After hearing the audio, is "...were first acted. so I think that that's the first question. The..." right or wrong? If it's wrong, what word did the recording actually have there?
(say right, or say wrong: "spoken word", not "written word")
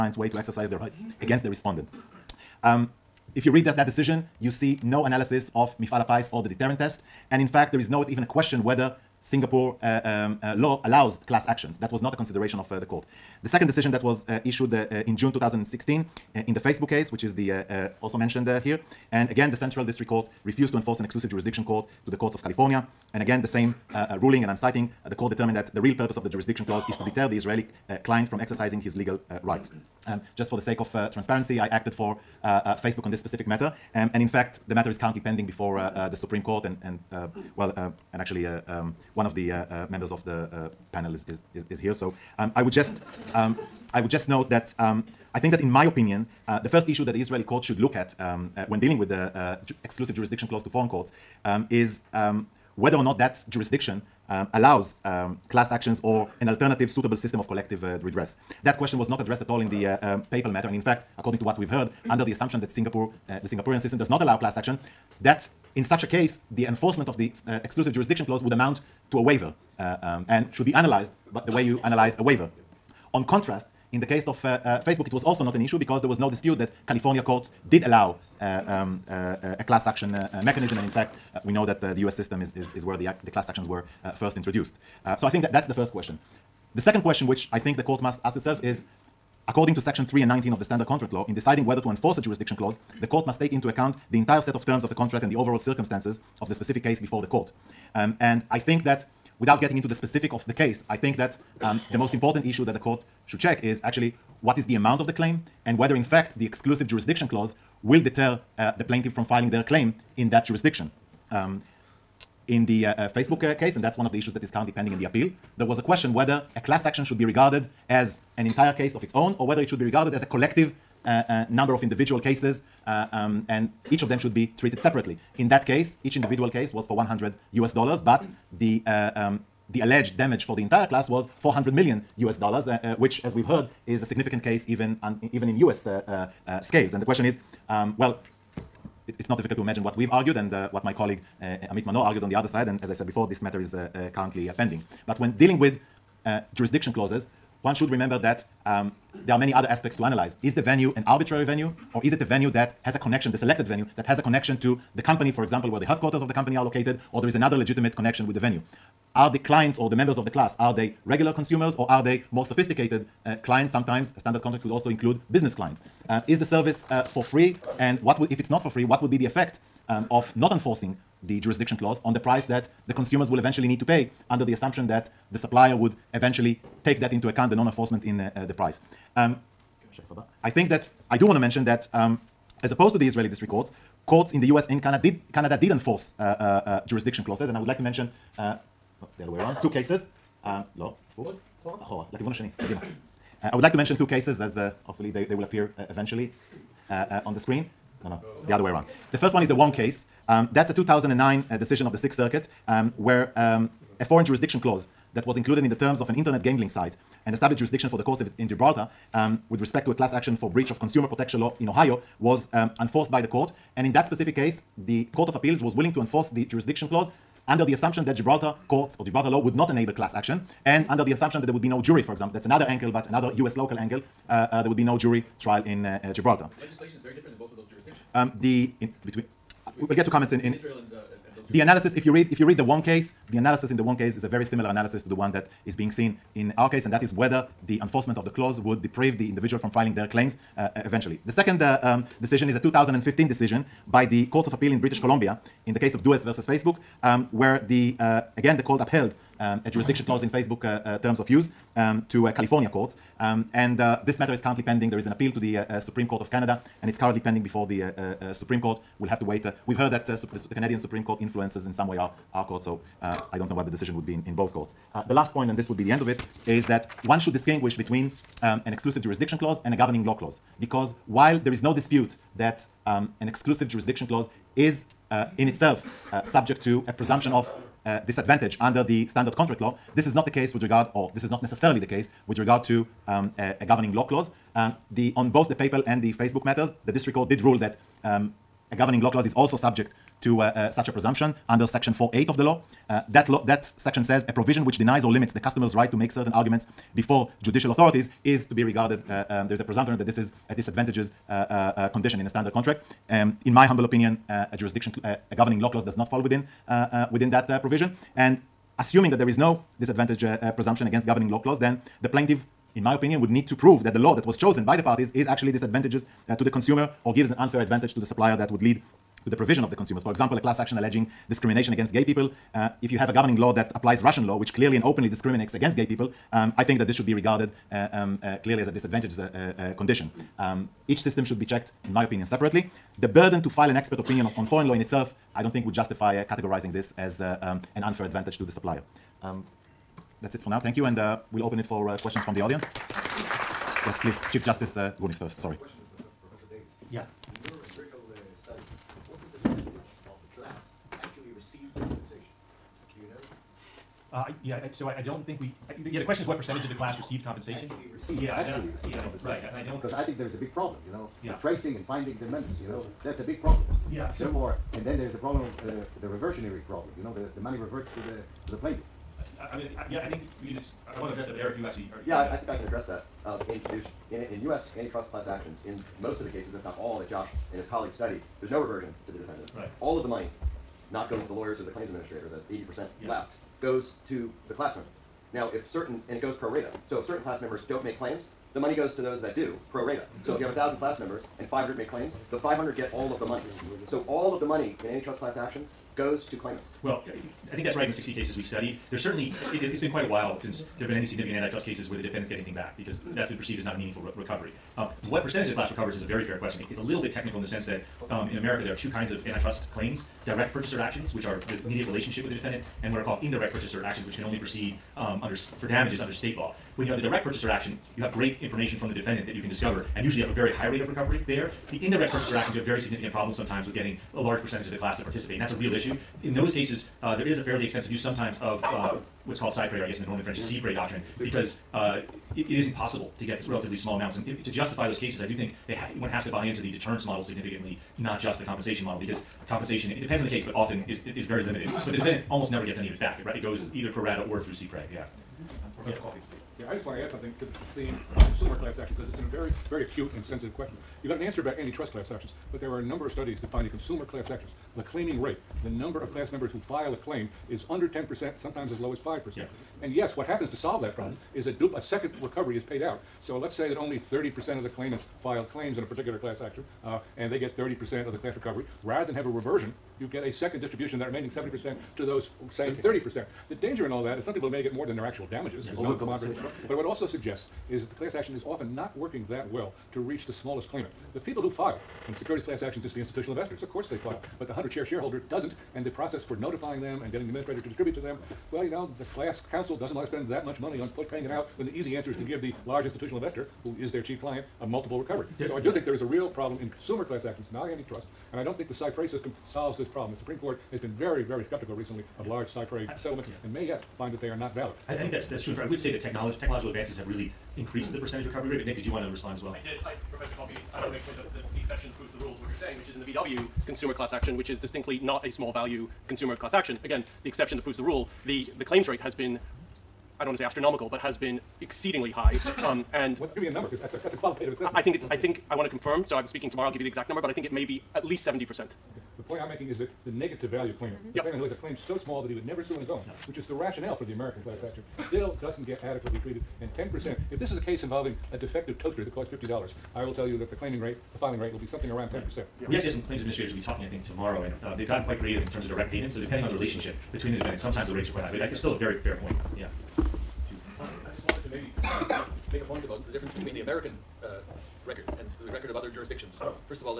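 wrong: "introduced", not "acted".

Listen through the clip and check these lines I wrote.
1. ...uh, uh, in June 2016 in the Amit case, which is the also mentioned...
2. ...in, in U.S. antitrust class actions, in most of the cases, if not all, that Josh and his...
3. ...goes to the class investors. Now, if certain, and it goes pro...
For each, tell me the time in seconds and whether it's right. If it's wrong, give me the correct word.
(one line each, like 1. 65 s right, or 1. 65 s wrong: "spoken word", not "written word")
1. 14 s wrong: "Facebook", not "Amit"
2. 374 s right
3. 383 s wrong: "members", not "investors".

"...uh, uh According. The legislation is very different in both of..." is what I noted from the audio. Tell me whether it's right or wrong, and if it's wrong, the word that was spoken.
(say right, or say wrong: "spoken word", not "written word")
wrong: "Gibraltar", not "According".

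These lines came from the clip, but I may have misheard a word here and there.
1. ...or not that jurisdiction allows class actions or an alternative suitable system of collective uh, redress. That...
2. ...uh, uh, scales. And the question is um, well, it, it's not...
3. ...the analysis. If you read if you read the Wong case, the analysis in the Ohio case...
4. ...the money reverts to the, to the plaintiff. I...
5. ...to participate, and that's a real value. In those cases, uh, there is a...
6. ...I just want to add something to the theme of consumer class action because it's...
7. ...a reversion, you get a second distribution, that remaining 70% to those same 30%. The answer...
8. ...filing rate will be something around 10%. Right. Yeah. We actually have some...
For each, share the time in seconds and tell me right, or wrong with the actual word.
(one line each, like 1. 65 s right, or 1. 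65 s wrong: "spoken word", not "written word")
1. 52 s right
2. 135 s right
3. 231 s wrong: "Wong", not "Ohio"
4. 367 s right
5. 424 s wrong: "issue", not "value"
6. 446 s right
7. 469 s wrong: "danger", not "answer"
8. 541 s right.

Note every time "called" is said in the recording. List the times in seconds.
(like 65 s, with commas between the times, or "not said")
413 s, 429 s.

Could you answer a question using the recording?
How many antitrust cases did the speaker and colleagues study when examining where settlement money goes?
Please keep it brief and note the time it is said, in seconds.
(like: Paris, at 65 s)
60, at 397 s.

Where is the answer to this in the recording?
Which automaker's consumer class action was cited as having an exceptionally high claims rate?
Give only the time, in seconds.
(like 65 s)
513 s.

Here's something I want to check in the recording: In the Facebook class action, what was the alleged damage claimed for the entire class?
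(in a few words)
400 million US dollars.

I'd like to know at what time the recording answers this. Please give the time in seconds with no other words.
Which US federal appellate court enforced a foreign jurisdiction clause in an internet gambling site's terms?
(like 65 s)
201 s.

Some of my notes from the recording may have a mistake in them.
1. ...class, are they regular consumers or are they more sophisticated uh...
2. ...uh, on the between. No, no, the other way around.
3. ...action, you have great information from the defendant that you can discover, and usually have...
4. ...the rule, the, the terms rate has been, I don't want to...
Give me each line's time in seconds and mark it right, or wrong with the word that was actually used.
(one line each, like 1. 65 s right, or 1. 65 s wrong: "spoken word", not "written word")
1. 160 s right
2. 196 s wrong: "screen", not "between"
3. 417 s right
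4. 517 s wrong: "claims", not "terms".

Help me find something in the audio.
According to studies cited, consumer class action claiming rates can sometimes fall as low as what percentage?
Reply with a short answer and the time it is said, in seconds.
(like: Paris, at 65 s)
5%, at 458 s.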